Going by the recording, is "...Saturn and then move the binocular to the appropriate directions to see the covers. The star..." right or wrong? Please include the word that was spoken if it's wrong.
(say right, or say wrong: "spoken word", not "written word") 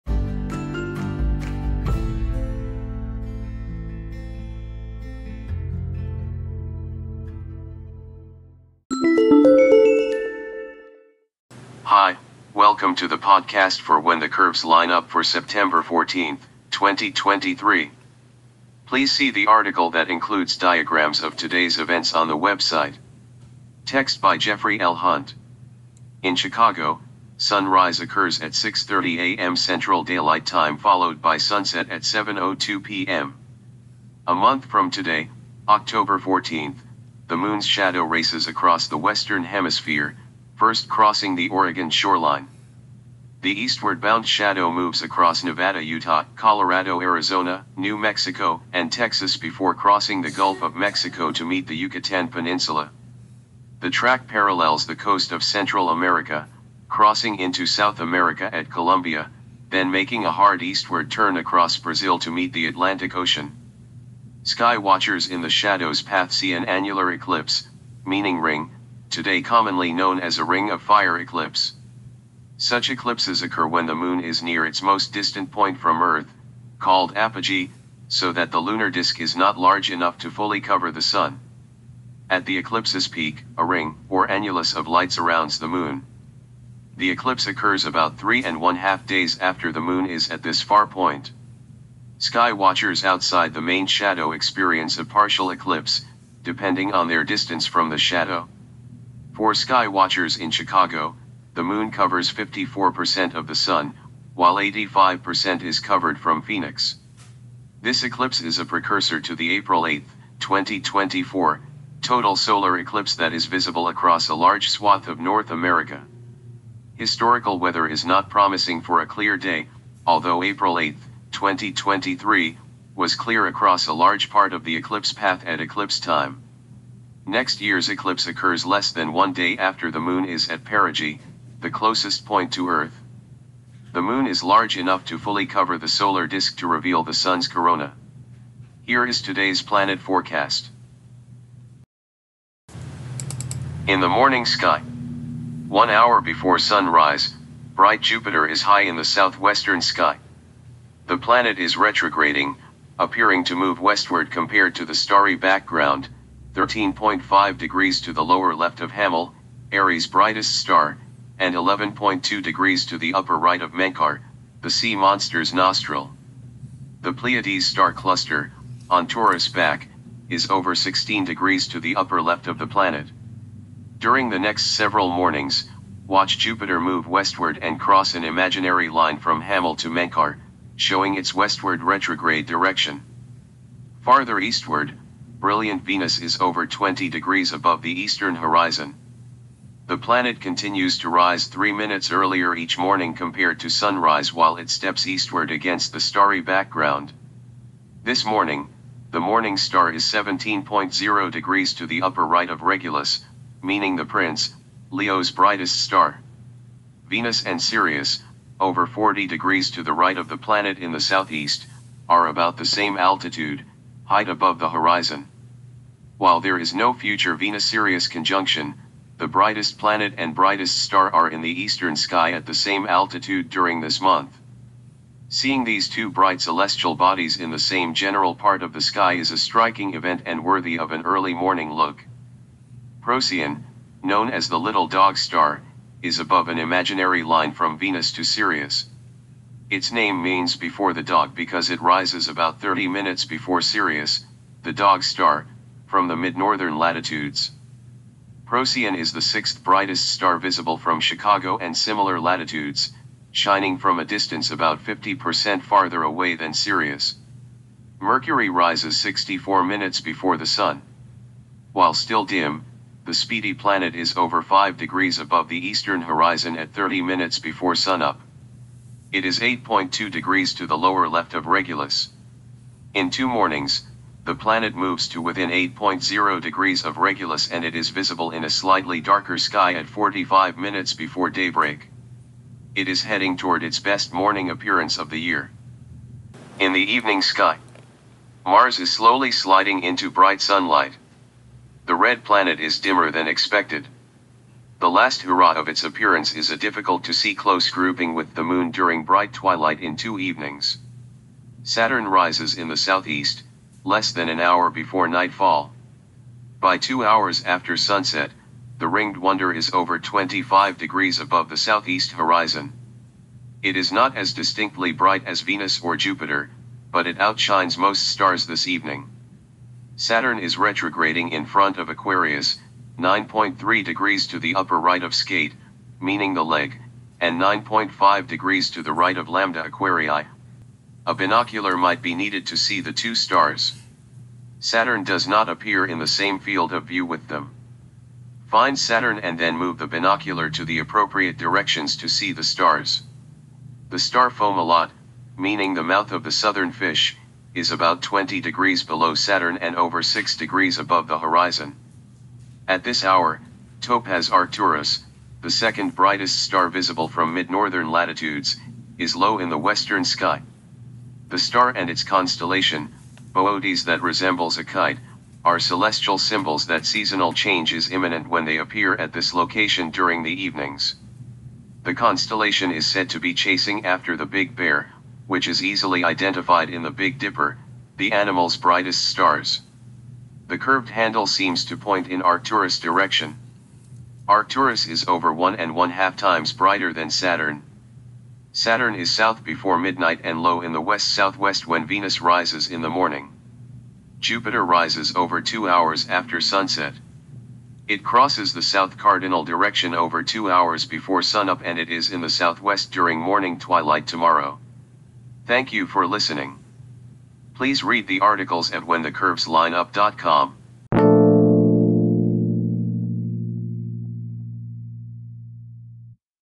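wrong: "stars", not "covers".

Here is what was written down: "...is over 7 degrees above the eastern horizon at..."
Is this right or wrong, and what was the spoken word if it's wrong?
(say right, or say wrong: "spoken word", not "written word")
wrong: "5", not "7".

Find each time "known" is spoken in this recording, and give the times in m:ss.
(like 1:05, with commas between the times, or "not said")
1:09, 3:54.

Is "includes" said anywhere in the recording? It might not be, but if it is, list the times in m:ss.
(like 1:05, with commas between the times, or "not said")
0:20.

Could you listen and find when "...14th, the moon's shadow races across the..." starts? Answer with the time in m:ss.
0:36.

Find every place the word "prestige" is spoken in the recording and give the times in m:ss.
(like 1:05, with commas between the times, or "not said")
not said.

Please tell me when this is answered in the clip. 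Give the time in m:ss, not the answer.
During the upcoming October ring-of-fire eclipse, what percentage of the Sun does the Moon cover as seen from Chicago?
1:42.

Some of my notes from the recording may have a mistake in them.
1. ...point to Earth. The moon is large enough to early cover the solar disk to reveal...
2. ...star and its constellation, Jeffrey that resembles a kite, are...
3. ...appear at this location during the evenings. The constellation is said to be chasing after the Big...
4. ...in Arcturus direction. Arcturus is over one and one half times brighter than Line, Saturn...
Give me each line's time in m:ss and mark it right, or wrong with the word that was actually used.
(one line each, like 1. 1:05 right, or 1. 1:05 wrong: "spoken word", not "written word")
1. 2:12 wrong: "fully", not "early"
2. 6:01 wrong: "Boötes", not "Jeffrey"
3. 6:08 right
4. 6:22 wrong: "Saturn", not "Line".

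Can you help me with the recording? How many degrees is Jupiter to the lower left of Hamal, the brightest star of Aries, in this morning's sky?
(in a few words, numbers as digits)
13.5 degrees.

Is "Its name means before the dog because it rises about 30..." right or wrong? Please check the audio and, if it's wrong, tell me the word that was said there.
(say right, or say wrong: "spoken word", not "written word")
right.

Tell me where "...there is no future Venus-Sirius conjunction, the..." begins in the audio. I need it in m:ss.
3:36.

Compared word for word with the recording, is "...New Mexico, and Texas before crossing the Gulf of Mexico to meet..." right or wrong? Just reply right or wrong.
right.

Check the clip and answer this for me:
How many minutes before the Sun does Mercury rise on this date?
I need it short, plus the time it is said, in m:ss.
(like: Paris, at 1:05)
64 minutes, at 4:18.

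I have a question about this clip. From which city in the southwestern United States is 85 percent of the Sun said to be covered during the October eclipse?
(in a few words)
Phoenix.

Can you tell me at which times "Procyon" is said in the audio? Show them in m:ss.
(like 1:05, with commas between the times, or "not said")
3:53, 4:08.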